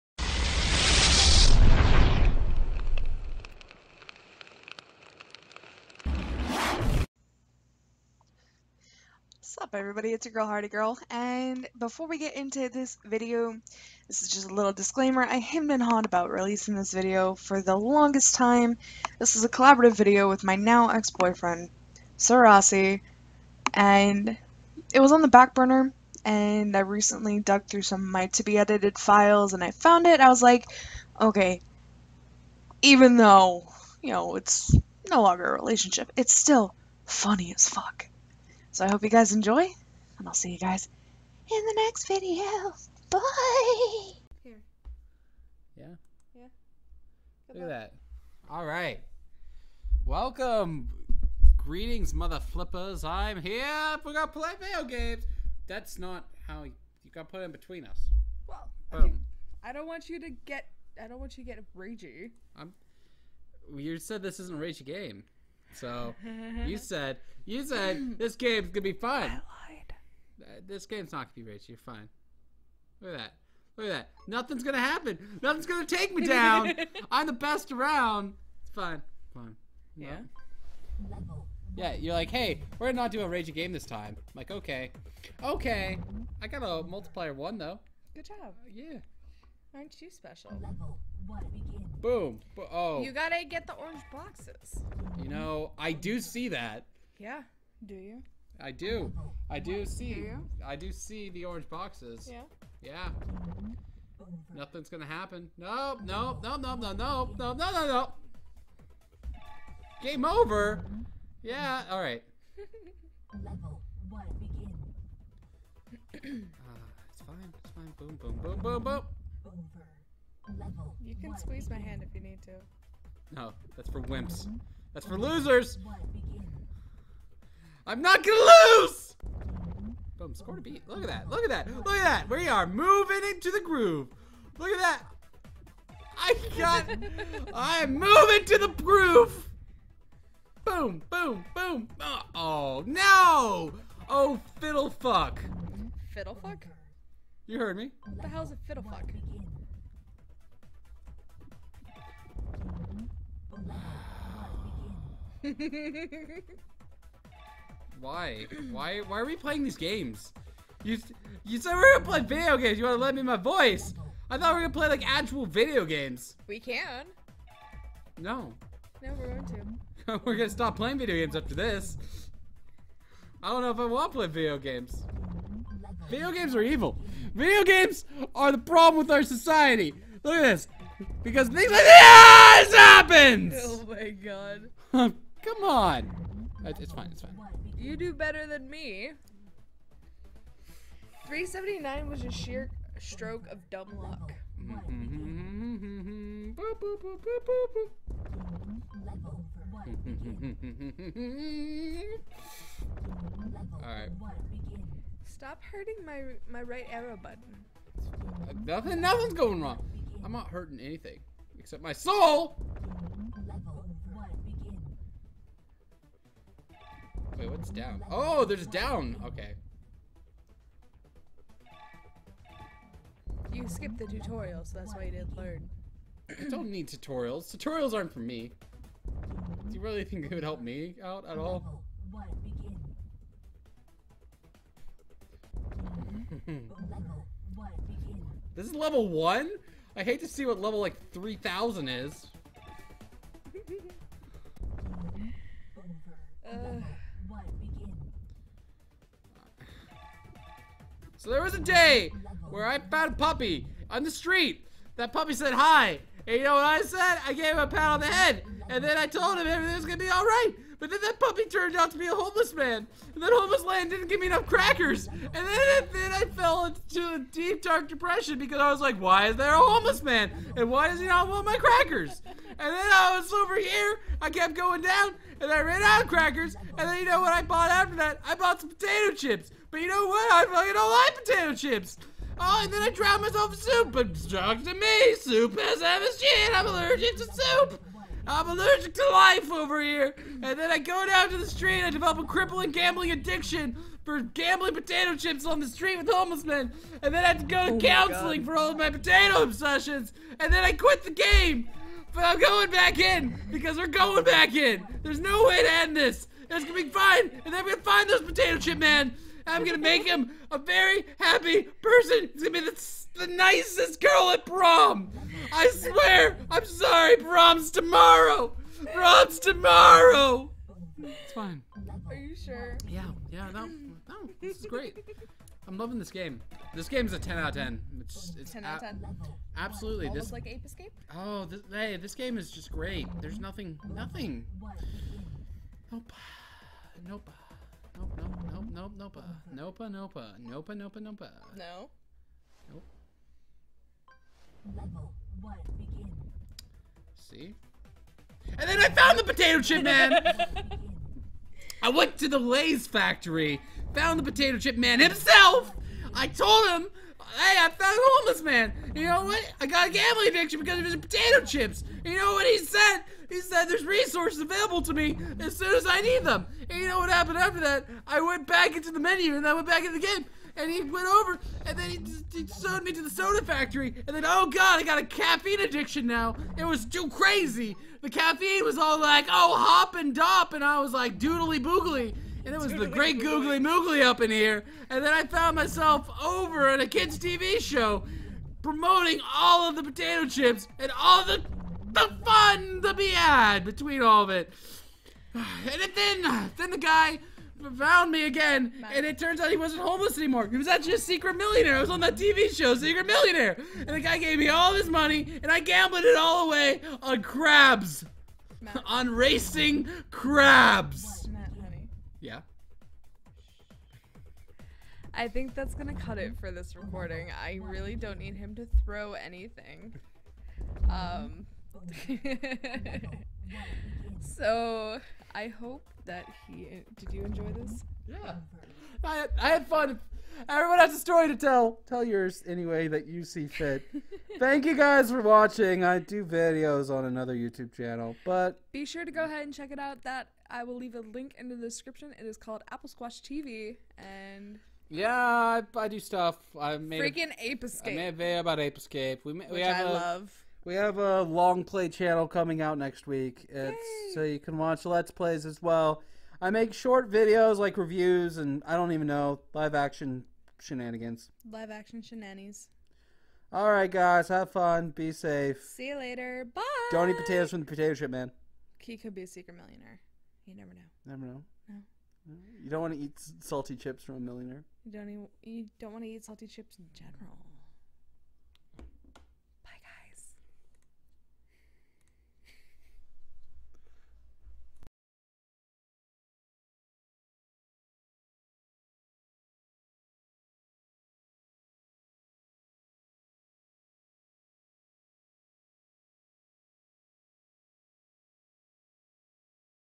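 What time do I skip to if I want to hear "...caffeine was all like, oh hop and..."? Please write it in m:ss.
6:18.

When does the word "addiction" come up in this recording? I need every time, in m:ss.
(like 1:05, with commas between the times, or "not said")
4:53, 6:00, 6:15.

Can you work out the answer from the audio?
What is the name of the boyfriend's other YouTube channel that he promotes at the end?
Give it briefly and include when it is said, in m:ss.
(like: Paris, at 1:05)
Apple Squash TV, at 7:22.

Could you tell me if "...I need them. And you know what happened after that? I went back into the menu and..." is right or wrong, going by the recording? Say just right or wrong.
right.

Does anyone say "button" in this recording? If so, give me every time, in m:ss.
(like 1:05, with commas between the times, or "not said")
3:27.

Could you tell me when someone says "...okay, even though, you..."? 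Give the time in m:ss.
0:31.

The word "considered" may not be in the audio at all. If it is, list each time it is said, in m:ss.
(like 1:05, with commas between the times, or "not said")
not said.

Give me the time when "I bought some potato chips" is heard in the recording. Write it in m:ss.
4:38.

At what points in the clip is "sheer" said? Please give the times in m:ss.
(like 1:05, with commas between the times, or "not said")
3:12.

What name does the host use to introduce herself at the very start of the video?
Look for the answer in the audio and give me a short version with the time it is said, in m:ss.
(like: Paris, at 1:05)
Hardy Girl, at 0:10.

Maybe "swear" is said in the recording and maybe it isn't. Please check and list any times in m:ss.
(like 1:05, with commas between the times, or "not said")
5:15.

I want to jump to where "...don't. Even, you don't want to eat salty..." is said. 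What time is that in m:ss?
7:54.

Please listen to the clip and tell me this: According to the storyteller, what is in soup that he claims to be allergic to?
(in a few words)
MSG.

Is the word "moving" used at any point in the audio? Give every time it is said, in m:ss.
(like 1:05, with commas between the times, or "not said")
2:12, 2:17.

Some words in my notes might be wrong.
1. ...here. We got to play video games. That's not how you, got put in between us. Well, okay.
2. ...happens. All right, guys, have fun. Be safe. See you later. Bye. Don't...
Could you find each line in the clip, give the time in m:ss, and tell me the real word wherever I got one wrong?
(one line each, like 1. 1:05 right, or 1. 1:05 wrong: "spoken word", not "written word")
1. 0:53 right
2. 7:42 wrong: "shenanigans", not "happens".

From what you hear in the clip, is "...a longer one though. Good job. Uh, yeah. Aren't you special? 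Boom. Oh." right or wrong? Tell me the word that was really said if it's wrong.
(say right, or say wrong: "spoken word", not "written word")
wrong: "multiplier", not "longer".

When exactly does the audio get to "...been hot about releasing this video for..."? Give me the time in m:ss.
0:15.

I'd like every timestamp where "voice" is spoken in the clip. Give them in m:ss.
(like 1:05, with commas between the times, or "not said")
2:43.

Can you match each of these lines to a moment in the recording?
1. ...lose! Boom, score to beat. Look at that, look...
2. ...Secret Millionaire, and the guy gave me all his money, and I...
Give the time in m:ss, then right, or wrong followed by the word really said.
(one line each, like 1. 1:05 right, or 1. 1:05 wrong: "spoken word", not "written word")
1. 2:08 right
2. 6:42 right.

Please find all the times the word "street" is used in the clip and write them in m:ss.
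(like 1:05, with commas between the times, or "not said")
4:14, 4:51, 4:55.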